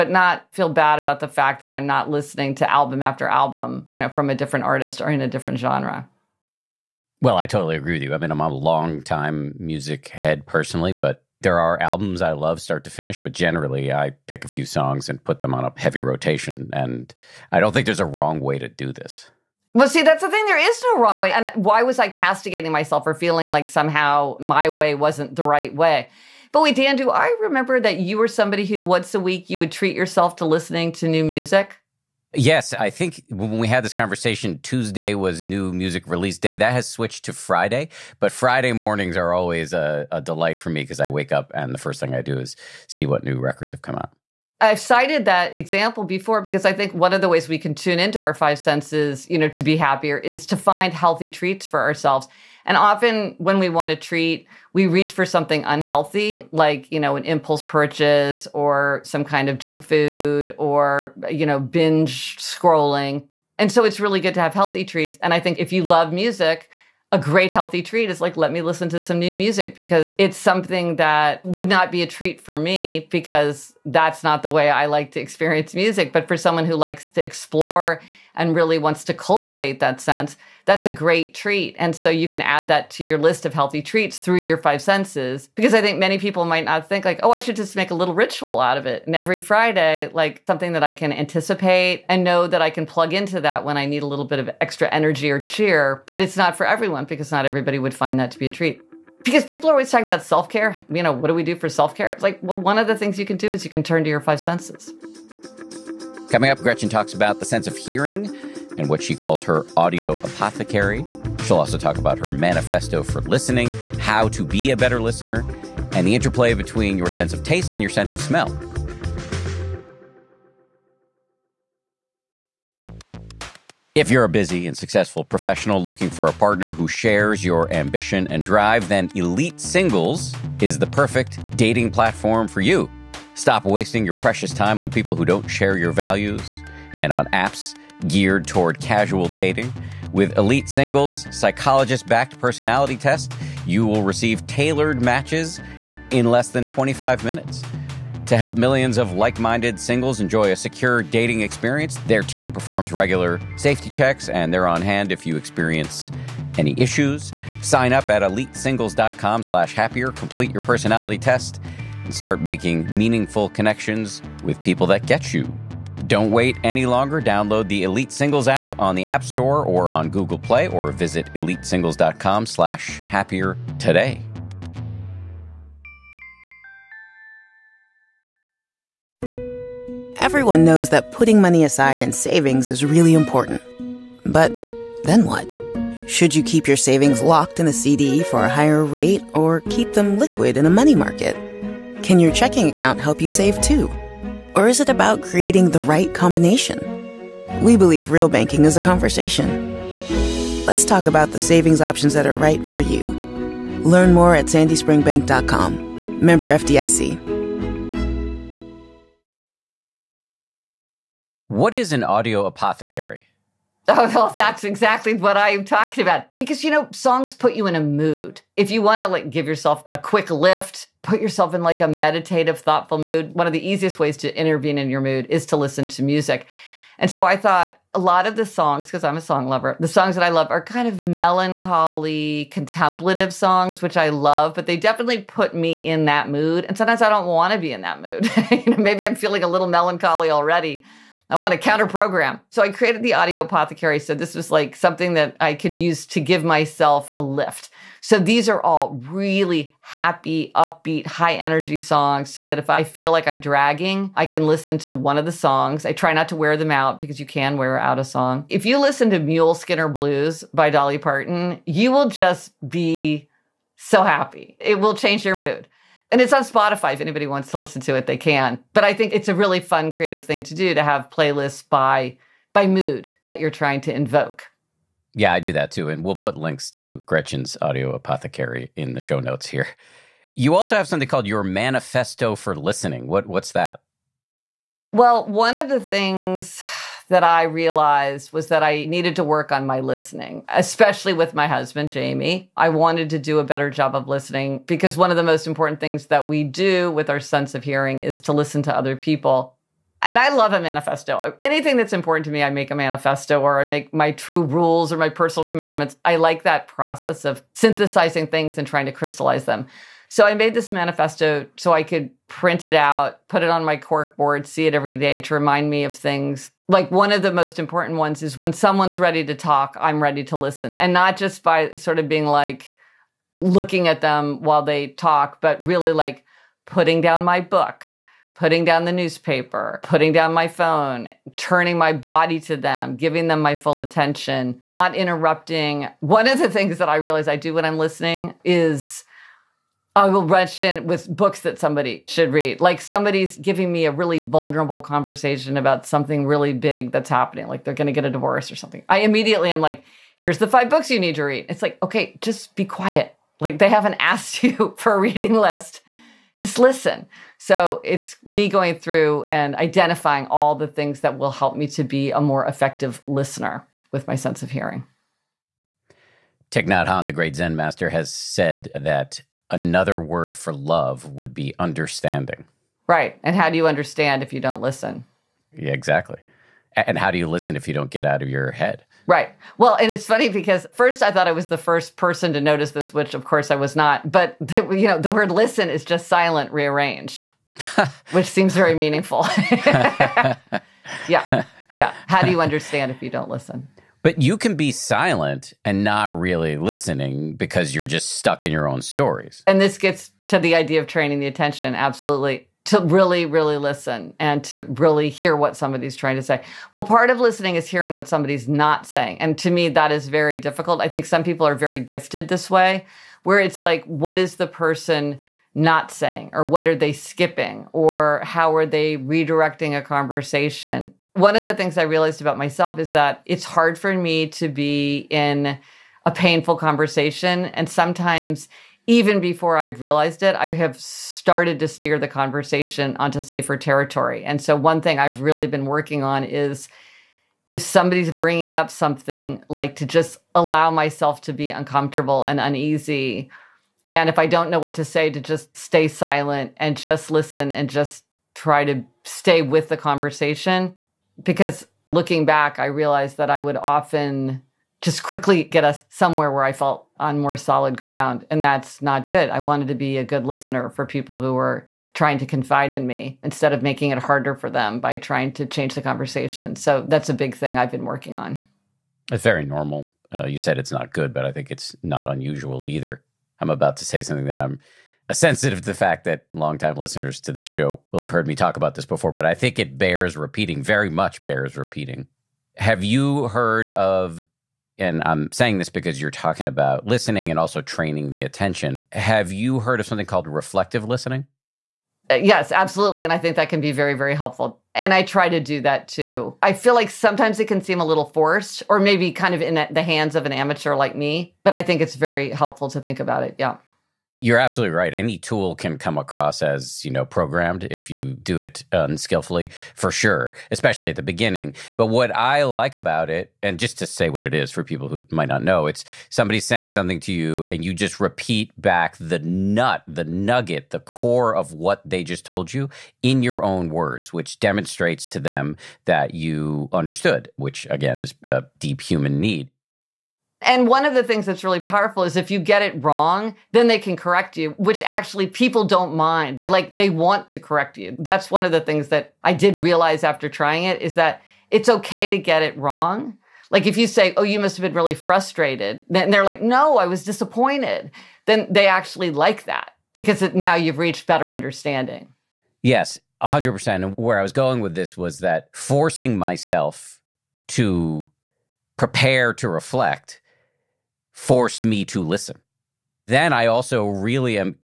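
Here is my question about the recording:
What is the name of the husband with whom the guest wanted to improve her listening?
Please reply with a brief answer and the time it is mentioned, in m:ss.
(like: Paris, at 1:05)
Jamie, at 4:51.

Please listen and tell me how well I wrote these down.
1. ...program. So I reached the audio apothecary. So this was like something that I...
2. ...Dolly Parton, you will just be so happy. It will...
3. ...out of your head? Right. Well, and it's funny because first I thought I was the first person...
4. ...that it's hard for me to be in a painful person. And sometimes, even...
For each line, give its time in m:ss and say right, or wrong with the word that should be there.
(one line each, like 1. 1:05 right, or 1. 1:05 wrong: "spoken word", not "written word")
1. 4:01 wrong: "created", not "reached"
2. 4:20 right
3. 6:18 right
4. 7:02 wrong: "conversation", not "person".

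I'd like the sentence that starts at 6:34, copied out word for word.
But you can be silent and not really listening because you're just stuck in your own stories.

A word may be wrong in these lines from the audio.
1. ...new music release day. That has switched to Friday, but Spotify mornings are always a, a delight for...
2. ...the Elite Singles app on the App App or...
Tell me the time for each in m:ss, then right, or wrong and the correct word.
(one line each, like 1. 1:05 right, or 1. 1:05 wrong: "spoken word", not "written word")
1. 0:35 wrong: "Friday", not "Spotify"
2. 2:47 wrong: "Store", not "App".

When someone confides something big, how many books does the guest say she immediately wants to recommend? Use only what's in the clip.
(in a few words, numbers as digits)
5.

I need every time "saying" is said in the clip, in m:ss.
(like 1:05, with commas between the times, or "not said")
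6:48, 6:55, 8:05, 8:36.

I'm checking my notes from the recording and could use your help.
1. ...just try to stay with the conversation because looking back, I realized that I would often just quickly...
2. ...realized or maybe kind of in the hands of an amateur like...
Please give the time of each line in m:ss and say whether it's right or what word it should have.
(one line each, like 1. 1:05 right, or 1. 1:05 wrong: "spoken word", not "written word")
1. 7:27 right
2. 8:18 wrong: "forced", not "realized".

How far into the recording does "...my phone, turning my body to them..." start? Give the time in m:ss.
5:30.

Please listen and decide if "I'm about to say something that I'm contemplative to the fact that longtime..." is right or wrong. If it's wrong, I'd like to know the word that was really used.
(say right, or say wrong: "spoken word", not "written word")
wrong: "sensitive", not "contemplative".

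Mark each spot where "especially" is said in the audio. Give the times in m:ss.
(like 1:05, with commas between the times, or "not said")
4:50, 8:30.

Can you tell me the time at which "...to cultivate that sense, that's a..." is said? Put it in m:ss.
1:19.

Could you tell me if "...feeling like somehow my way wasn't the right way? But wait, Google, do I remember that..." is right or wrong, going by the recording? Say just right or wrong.
wrong.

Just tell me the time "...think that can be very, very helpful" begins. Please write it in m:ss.
8:13.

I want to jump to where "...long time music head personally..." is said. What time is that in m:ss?
0:08.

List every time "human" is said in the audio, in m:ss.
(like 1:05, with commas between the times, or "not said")
8:48.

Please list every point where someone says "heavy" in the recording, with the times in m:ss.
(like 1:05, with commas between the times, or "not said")
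0:15.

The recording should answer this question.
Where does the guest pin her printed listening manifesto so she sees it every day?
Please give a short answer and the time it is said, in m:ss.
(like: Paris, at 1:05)
cork board, at 5:13.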